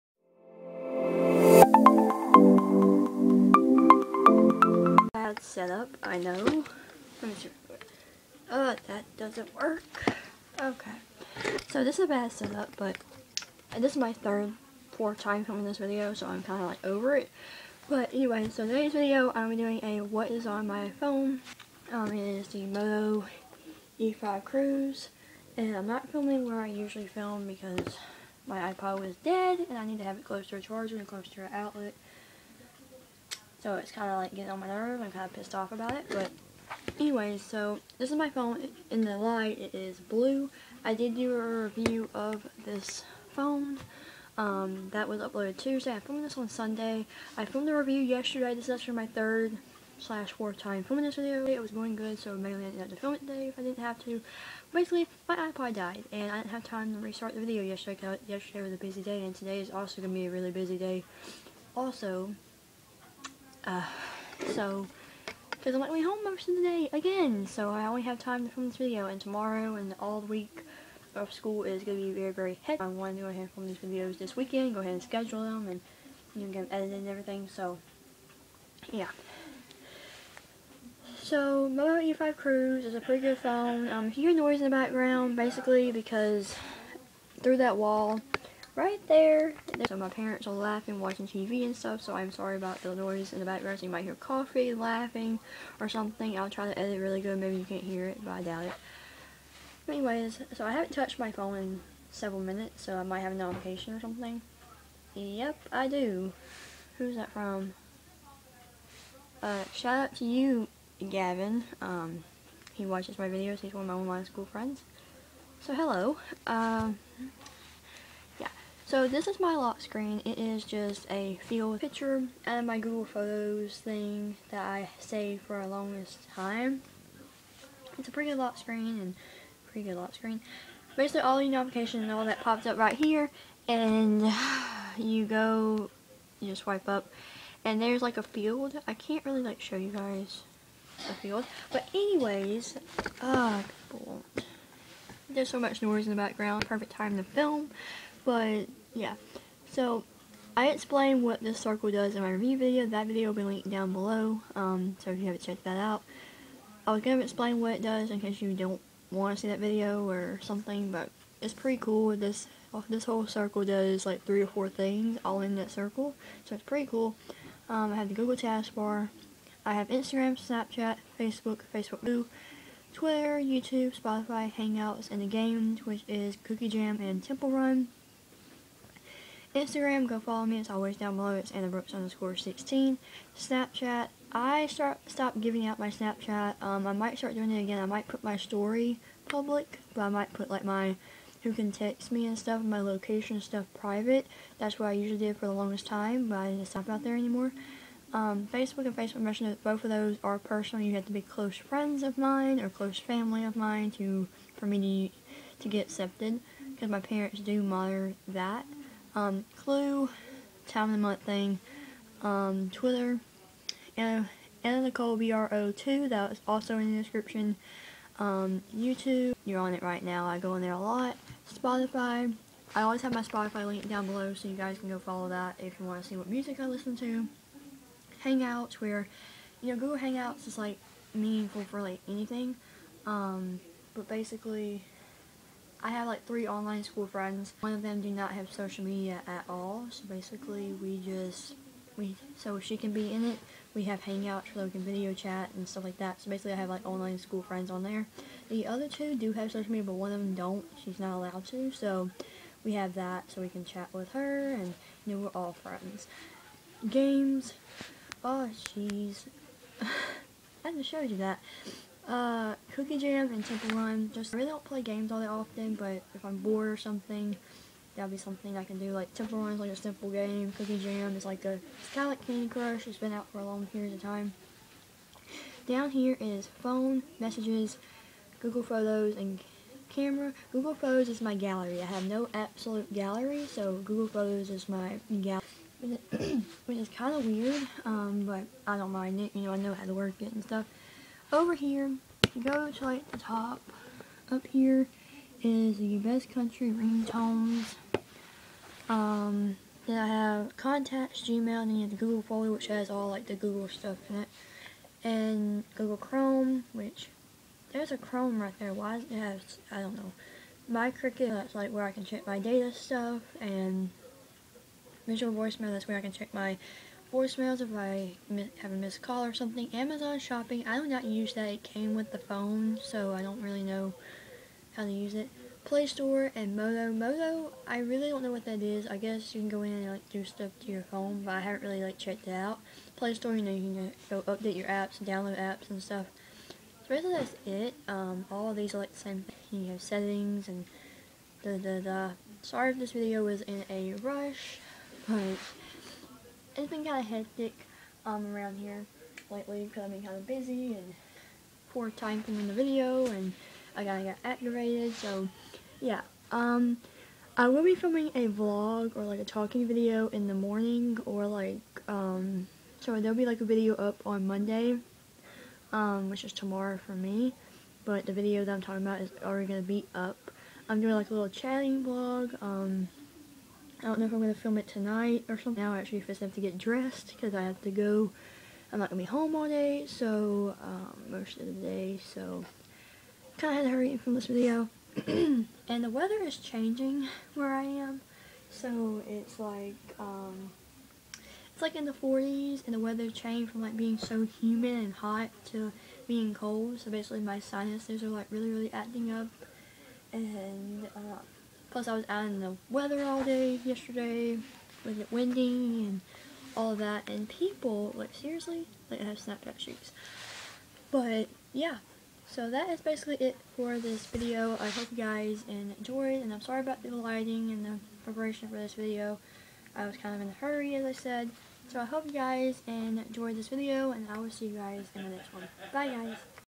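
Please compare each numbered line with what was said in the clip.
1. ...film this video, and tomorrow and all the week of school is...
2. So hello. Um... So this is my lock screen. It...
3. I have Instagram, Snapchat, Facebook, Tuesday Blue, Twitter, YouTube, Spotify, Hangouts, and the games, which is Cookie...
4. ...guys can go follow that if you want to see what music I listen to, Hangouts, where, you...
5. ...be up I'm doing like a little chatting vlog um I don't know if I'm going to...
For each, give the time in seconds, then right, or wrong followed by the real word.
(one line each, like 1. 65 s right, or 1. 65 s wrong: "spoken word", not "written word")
1. 68 s right
2. 115 s right
3. 169 s wrong: "Facebook", not "Tuesday"
4. 224 s right
5. 369 s right.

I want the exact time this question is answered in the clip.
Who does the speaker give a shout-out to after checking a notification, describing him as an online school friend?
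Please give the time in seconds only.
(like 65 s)
111 s.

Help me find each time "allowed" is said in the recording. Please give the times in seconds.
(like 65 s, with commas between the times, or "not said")
251 s.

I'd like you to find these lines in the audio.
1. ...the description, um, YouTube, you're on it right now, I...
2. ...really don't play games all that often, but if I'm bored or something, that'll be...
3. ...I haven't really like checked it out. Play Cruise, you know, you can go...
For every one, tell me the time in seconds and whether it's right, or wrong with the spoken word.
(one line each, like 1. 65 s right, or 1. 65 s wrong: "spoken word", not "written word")
1. 216 s right
2. 264 s right
3. 331 s wrong: "Store", not "Cruise".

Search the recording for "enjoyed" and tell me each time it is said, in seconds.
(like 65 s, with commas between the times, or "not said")
415 s, 422 s.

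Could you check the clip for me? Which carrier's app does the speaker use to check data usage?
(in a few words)
Cricket.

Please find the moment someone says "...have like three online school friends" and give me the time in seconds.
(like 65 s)
235 s.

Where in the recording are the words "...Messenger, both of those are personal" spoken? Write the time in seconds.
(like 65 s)
199 s.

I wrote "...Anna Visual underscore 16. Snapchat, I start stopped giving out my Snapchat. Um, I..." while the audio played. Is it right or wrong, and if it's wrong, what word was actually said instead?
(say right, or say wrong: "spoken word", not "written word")
wrong: "Brooks", not "Visual".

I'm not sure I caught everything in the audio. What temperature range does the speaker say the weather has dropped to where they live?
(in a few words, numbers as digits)
the 40s.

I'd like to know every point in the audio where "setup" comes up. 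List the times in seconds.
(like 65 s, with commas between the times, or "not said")
5 s, 12 s.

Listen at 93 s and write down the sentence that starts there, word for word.
So you might hear coffee, laughing, or something.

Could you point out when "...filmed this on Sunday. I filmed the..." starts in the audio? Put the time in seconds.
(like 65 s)
45 s.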